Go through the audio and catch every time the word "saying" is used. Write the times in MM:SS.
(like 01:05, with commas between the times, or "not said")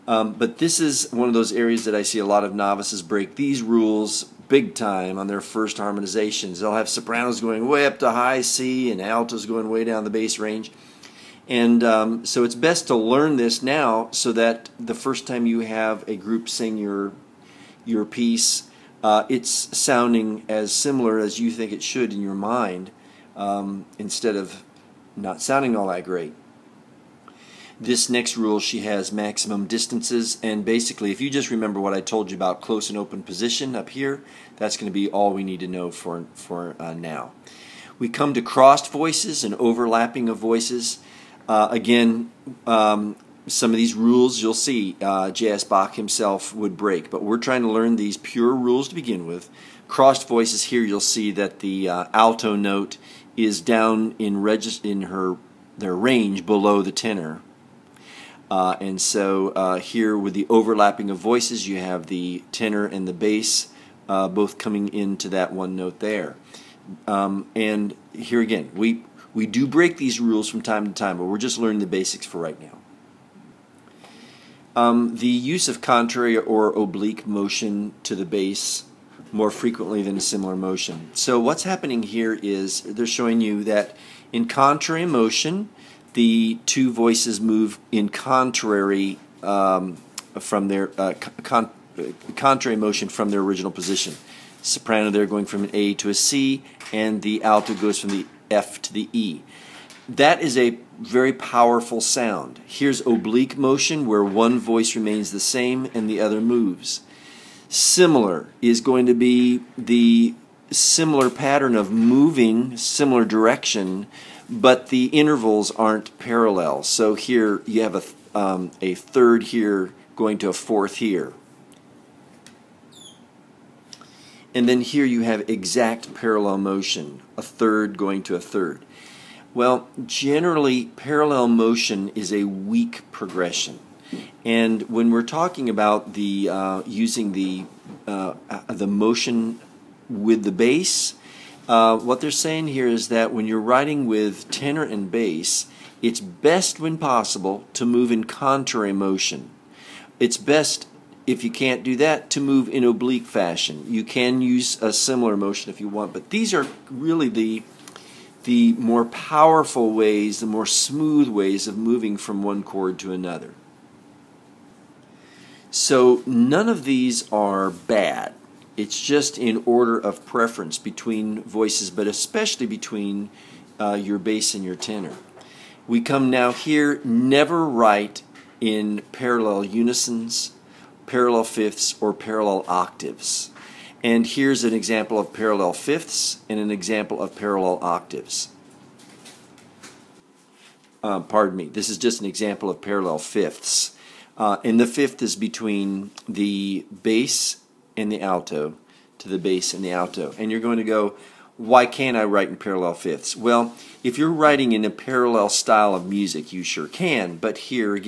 02:22.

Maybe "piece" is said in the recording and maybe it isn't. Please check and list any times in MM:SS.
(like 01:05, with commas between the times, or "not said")
00:18.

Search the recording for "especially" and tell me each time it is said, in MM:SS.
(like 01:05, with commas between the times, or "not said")
02:52.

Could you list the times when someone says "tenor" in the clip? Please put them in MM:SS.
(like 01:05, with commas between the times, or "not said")
00:56, 01:02, 02:24, 02:54.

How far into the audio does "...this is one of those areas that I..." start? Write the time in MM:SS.
00:00.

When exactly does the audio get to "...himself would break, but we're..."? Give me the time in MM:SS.
00:45.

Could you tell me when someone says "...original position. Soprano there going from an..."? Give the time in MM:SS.
01:33.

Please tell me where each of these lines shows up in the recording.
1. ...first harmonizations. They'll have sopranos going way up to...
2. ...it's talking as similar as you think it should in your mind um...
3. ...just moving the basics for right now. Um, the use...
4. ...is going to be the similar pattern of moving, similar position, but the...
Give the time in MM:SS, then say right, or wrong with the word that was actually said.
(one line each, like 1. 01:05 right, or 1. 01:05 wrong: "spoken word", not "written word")
1. 00:05 right
2. 00:19 wrong: "sounding", not "talking"
3. 01:11 wrong: "learning", not "moving"
4. 01:48 wrong: "direction", not "position".